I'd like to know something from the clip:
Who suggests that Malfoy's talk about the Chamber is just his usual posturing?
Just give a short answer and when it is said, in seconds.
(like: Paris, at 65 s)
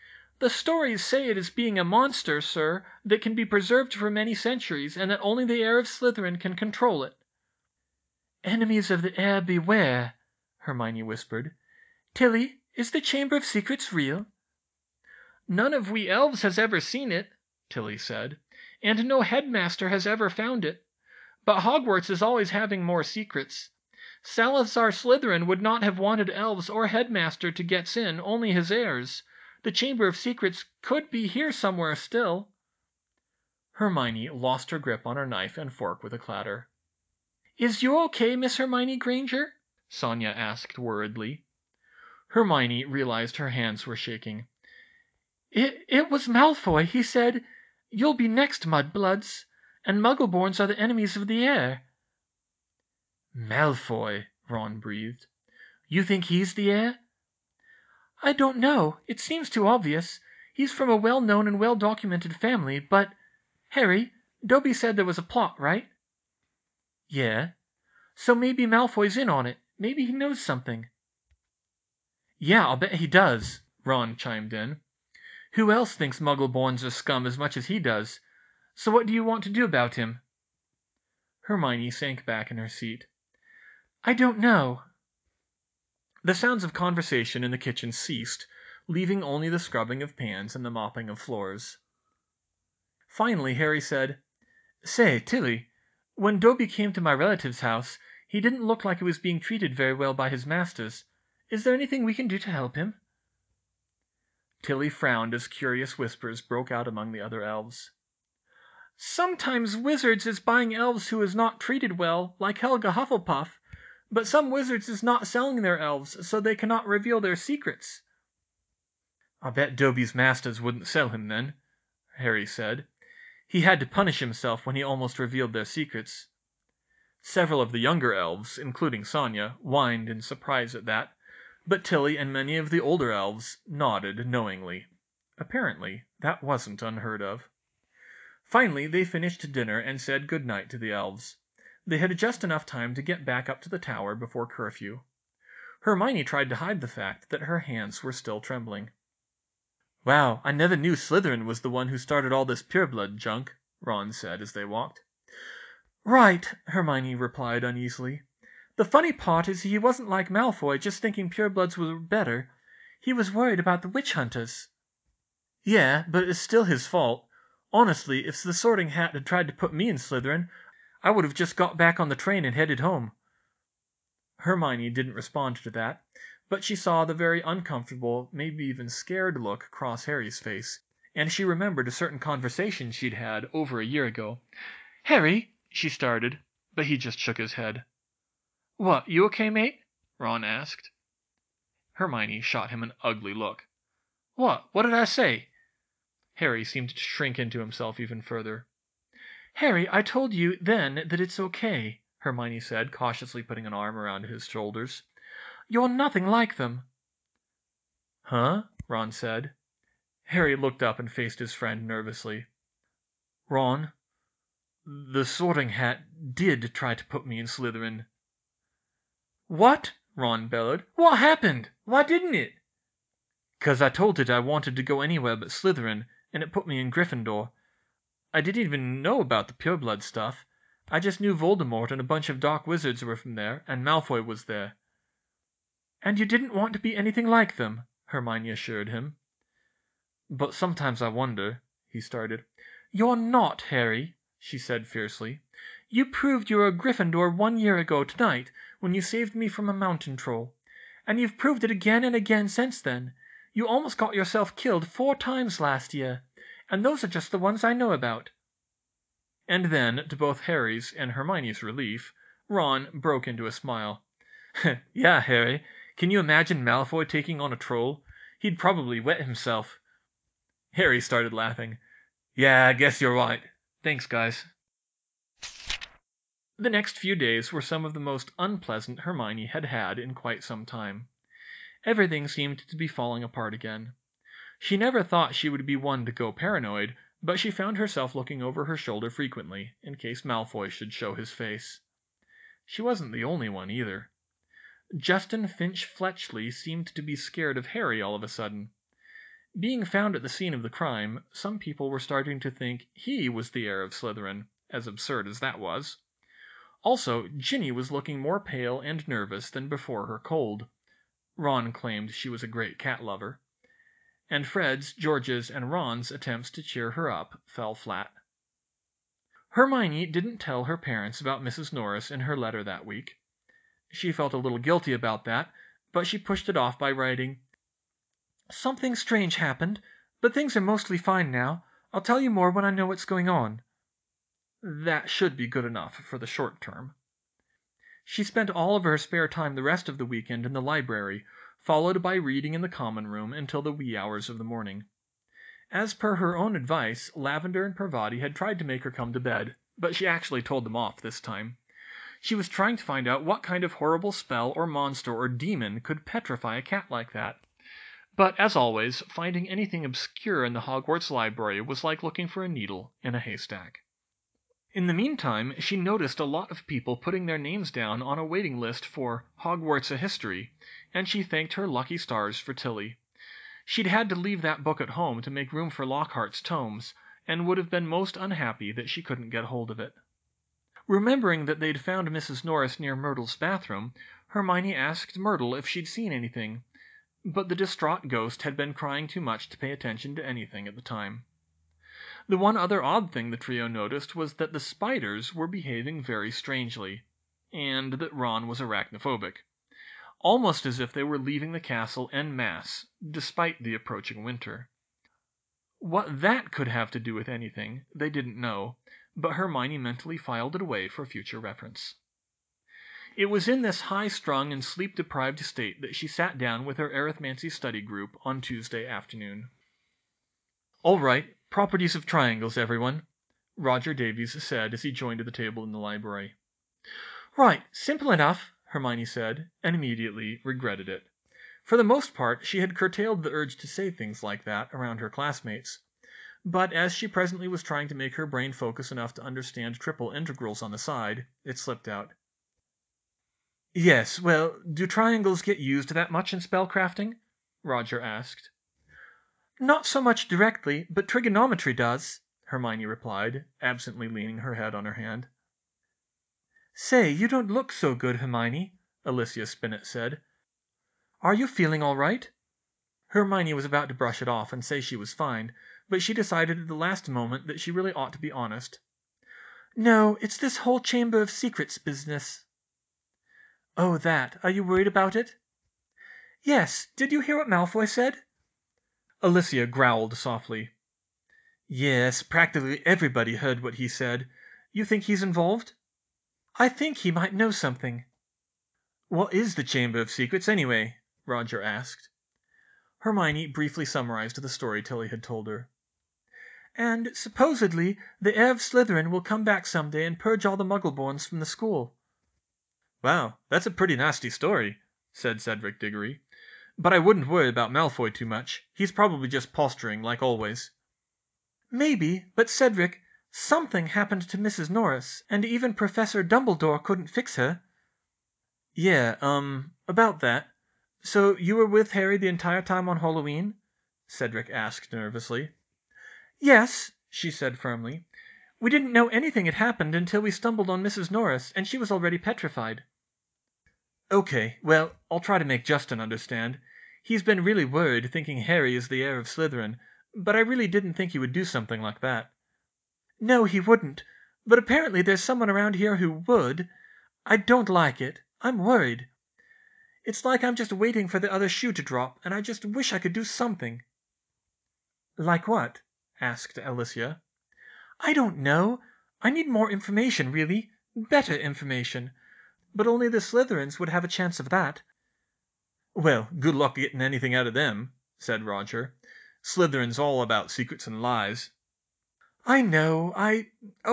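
Cedric Diggory, at 505 s.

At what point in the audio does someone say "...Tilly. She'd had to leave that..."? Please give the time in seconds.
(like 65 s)
372 s.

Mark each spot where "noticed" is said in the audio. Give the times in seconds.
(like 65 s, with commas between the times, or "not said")
365 s, 393 s.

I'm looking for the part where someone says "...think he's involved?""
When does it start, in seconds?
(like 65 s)
484 s.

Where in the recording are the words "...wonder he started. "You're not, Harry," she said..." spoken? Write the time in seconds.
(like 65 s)
241 s.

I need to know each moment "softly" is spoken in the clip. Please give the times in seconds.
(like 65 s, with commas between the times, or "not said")
480 s.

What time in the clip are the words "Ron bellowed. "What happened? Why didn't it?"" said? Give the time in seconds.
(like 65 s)
220 s.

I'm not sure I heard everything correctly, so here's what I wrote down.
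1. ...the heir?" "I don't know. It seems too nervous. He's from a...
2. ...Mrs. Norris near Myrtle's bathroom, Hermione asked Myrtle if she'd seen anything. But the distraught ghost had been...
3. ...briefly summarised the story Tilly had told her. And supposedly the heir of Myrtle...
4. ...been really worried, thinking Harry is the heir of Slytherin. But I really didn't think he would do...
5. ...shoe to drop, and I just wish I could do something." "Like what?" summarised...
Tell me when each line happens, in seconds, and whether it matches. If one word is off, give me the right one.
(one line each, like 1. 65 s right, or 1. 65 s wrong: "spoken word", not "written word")
1. 56 s wrong: "obvious", not "nervous"
2. 382 s right
3. 493 s wrong: "Slytherin", not "Myrtle"
4. 537 s right
5. 551 s wrong: "asked", not "summarised".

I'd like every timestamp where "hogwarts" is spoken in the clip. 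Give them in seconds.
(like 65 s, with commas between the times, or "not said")
21 s, 360 s, 369 s.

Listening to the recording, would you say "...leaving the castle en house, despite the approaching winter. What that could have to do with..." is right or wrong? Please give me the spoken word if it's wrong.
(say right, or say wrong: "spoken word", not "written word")
wrong: "masse", not "house".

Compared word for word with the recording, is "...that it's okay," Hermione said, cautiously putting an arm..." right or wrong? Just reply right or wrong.
right.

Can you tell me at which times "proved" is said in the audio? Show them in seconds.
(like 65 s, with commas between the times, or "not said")
246 s, 251 s.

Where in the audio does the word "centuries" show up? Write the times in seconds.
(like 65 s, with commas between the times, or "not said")
4 s.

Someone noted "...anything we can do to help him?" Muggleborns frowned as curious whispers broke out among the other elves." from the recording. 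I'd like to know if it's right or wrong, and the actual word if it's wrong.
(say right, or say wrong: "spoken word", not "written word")
wrong: "Tilly", not "Muggleborns".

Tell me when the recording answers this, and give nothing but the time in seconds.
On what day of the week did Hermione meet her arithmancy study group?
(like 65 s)
418 s.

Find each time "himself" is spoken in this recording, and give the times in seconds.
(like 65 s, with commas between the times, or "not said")
124 s, 197 s, 269 s.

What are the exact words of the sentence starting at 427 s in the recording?
"Right, simple enough," Hermione said, and immediately regretted it.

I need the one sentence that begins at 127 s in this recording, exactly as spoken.
Several of the younger elves, including Sonya, whined in surprise at that, but Tilly and many of the older elves nodded knowingly.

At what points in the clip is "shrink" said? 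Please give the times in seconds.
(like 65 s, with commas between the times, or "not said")
196 s.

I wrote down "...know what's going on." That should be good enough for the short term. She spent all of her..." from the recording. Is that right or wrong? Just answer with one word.
right.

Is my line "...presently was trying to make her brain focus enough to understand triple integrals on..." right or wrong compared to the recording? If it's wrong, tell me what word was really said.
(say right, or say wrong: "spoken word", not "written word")
right.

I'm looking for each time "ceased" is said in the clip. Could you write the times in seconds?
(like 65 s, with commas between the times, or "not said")
87 s.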